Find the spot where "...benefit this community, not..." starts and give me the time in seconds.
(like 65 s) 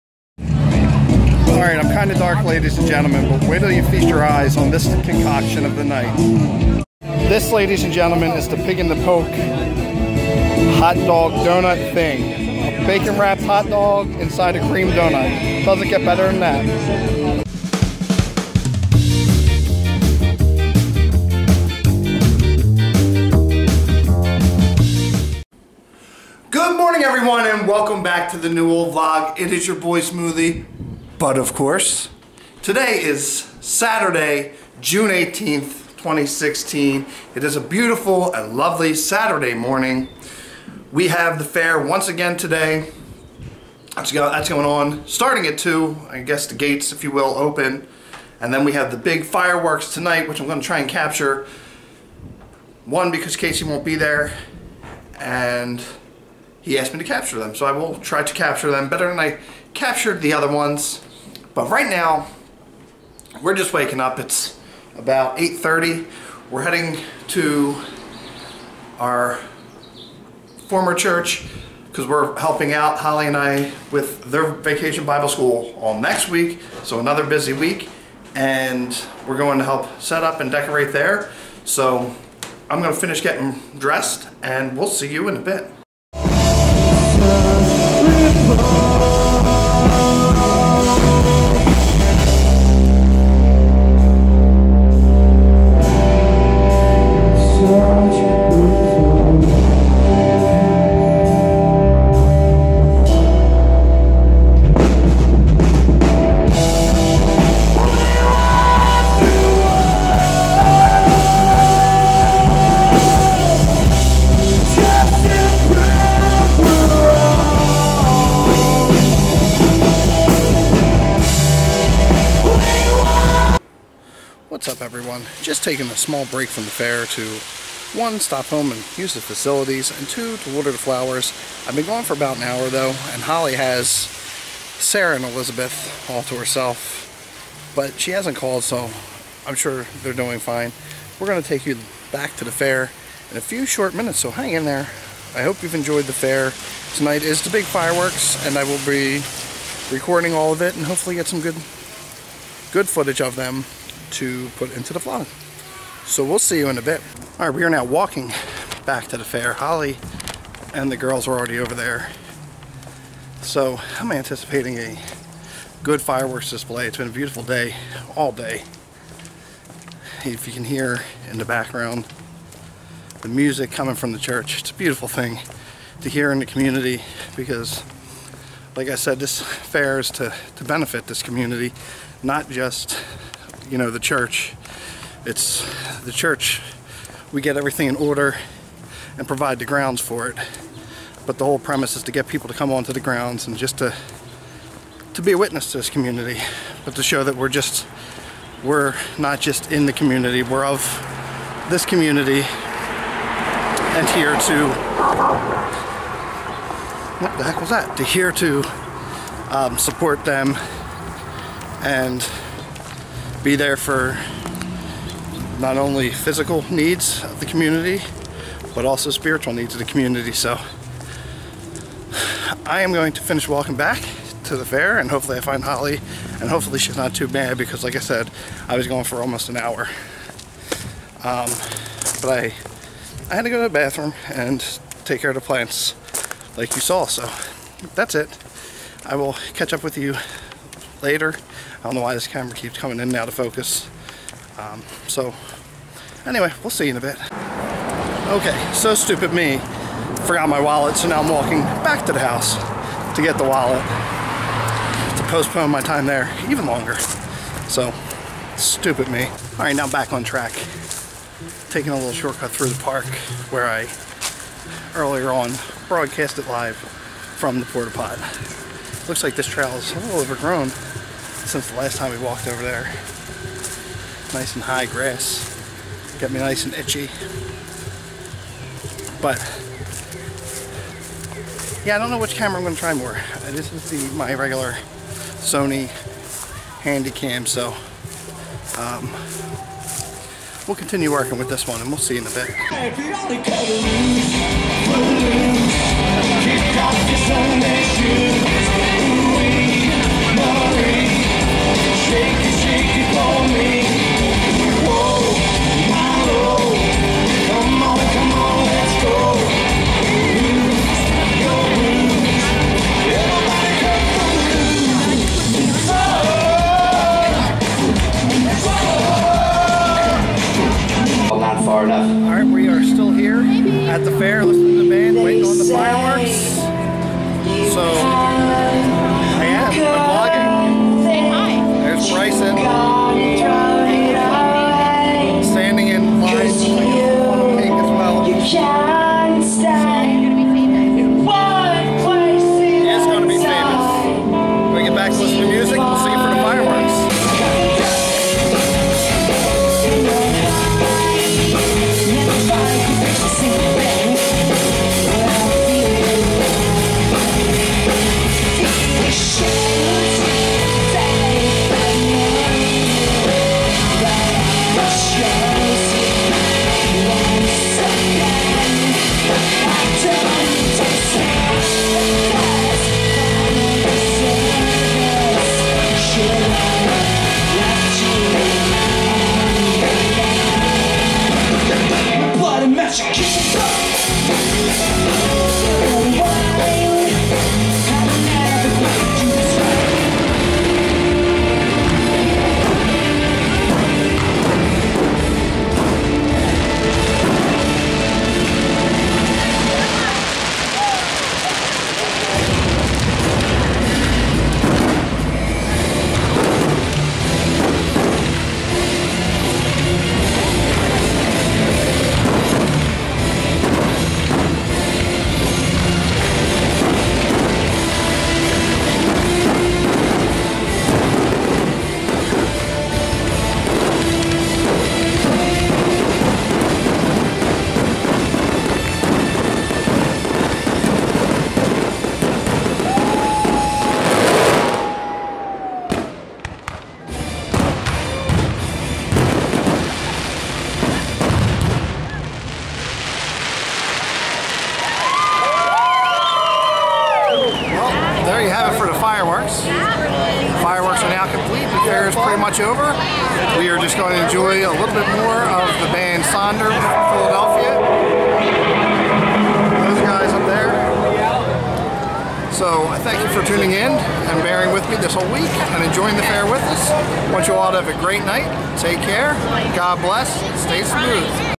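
180 s.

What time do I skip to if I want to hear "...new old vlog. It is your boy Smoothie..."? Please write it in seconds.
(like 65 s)
28 s.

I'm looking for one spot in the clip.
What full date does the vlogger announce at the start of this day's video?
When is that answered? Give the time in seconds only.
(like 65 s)
33 s.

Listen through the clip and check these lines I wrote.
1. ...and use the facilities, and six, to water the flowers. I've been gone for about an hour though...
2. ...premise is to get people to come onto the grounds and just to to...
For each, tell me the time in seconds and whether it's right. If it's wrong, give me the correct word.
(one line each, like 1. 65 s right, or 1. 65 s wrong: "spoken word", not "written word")
1. 128 s wrong: "two", not "six"
2. 191 s right.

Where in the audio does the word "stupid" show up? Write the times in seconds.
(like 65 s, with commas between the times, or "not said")
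248 s, 258 s.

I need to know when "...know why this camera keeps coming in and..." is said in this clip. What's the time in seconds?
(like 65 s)
241 s.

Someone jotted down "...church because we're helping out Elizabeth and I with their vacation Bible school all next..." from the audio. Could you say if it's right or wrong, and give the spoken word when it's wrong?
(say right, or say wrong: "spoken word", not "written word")
wrong: "Holly", not "Elizabeth".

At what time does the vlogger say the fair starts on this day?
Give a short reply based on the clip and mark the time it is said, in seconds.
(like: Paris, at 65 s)
2, at 45 s.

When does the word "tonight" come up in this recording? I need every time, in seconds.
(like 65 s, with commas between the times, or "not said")
49 s, 146 s.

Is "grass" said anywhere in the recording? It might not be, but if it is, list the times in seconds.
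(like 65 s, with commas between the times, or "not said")
274 s.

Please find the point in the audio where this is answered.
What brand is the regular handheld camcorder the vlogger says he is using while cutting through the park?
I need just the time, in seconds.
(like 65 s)
285 s.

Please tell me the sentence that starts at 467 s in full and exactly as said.
Want you all to have a great night.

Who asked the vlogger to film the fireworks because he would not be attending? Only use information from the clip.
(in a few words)
Casey.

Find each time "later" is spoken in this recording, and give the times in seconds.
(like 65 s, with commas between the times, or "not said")
241 s.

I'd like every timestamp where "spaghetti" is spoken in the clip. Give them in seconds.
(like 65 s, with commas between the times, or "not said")
not said.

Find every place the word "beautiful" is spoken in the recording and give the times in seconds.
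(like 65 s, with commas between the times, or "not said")
37 s, 167 s, 174 s.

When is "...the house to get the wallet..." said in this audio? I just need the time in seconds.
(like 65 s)
252 s.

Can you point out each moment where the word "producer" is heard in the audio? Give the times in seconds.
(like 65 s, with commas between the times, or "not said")
not said.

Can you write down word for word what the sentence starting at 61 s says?
But right now, we're just waking up.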